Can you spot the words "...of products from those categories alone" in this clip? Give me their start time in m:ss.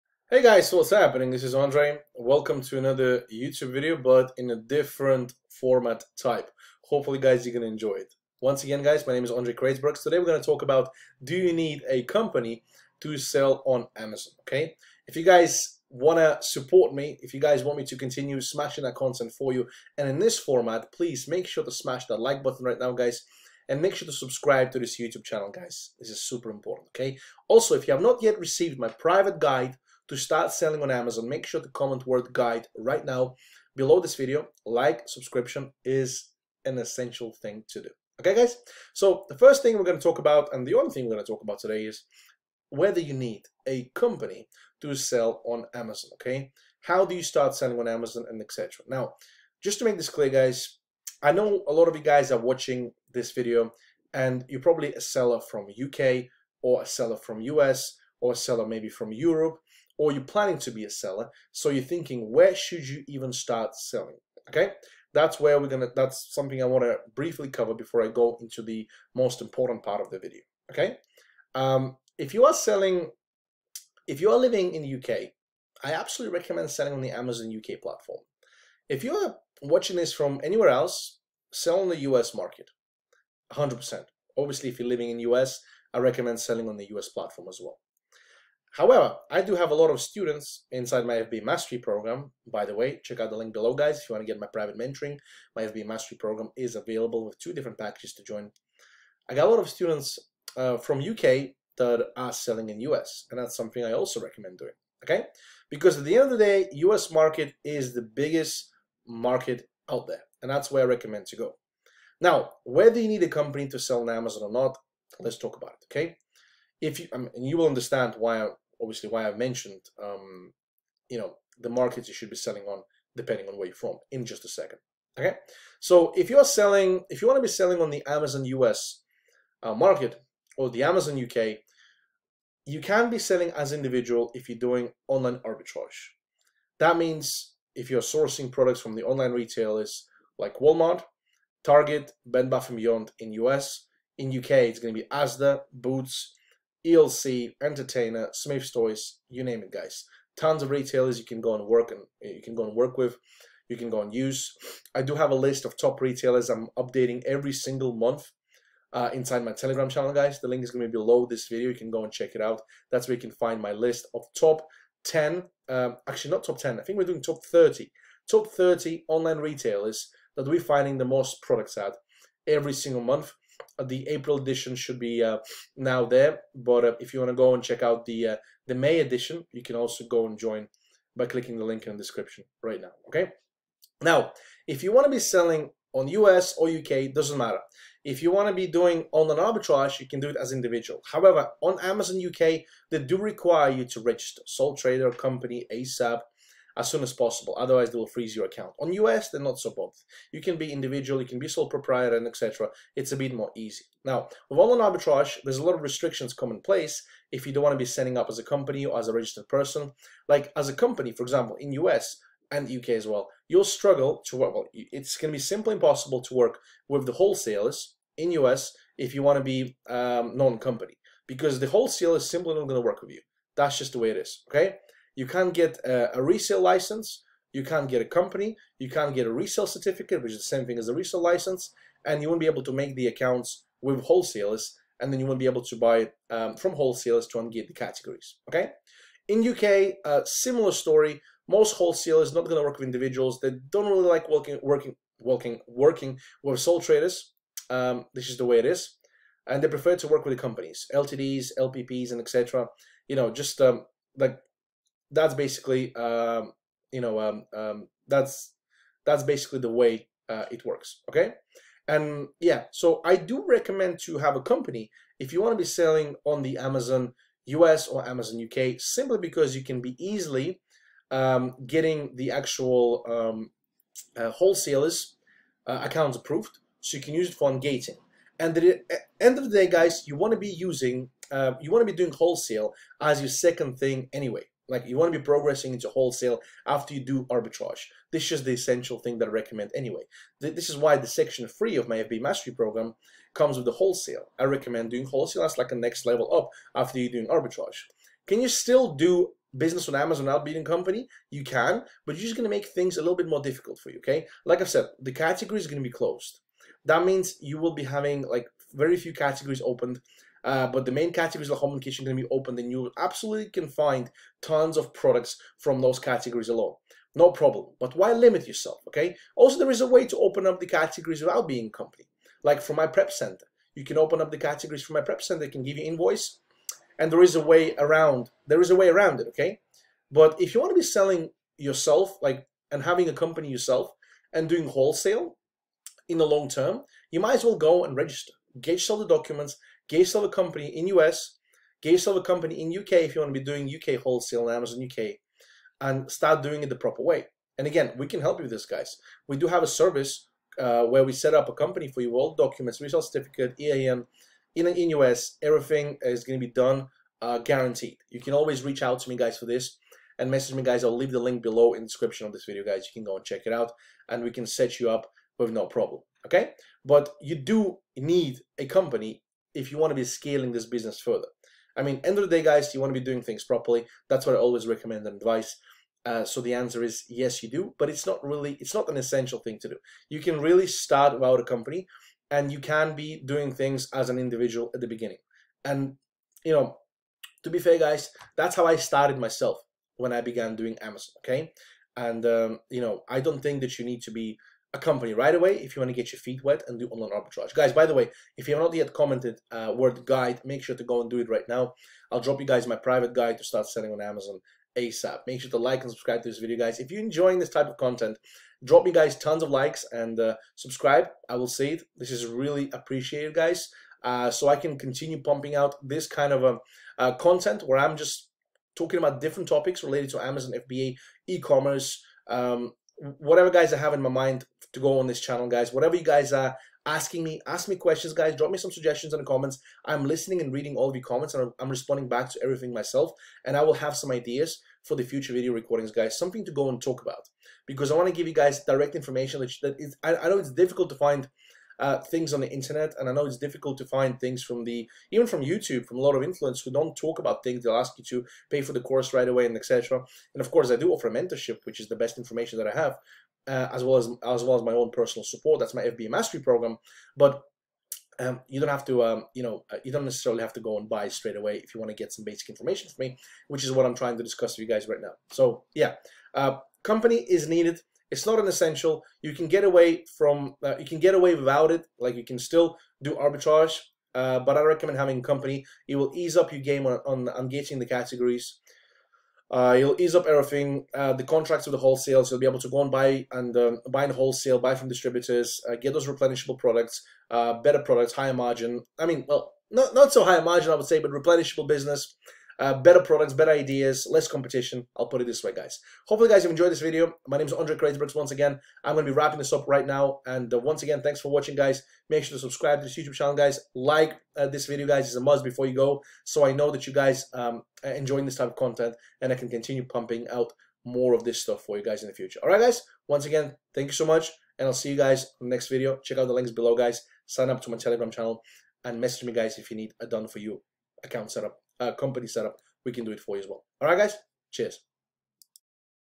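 5:14.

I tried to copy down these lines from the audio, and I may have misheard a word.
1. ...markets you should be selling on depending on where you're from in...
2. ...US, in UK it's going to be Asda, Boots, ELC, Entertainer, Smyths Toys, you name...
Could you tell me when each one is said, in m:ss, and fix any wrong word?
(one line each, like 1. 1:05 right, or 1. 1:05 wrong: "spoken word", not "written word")
1. 2:01 right
2. 2:23 right.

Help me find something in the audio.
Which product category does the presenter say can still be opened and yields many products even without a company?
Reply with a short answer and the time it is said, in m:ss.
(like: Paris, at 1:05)
home and kitchen, at 5:11.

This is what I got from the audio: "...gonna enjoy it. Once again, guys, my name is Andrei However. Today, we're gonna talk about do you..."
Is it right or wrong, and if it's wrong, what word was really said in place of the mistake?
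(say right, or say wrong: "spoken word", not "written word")
wrong: "Kreicberg", not "However".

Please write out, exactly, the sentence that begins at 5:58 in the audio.
You can always reach out to me, guys, for this and message me, guys.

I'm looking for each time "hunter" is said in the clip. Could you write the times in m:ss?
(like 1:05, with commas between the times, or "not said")
not said.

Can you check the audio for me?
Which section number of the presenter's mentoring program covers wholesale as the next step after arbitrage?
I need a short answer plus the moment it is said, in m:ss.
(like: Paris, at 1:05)
3, at 4:51.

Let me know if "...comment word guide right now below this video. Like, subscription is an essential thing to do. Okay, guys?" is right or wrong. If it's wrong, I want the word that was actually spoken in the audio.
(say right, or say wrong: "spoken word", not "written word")
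right.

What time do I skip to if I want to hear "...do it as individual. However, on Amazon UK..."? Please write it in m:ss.
3:10.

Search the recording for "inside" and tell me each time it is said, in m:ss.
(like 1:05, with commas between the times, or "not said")
1:30, 2:39.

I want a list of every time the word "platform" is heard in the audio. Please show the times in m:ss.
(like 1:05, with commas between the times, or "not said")
1:17, 1:27.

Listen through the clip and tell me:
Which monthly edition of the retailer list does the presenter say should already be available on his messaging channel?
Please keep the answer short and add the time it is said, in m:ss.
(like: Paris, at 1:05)
April, at 2:53.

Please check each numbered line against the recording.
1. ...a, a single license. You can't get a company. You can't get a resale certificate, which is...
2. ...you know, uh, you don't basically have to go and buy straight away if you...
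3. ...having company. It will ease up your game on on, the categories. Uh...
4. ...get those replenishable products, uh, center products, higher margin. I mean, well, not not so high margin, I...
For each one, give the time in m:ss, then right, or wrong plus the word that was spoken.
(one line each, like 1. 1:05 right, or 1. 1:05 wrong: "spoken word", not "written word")
1. 3:45 wrong: "resale", not "single"
2. 7:39 wrong: "necessarily", not "basically"
3. 7:54 right
4. 8:05 wrong: "better", not "center".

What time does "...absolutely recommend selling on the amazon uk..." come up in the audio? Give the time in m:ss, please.
1:15.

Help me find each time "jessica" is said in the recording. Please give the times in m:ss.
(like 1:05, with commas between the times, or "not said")
not said.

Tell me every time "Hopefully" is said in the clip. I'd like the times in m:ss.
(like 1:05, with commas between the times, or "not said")
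0:06, 8:16.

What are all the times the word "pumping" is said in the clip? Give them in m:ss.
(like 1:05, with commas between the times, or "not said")
6:55, 8:29.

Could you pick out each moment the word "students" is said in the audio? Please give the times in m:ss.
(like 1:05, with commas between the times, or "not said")
1:29, 1:39.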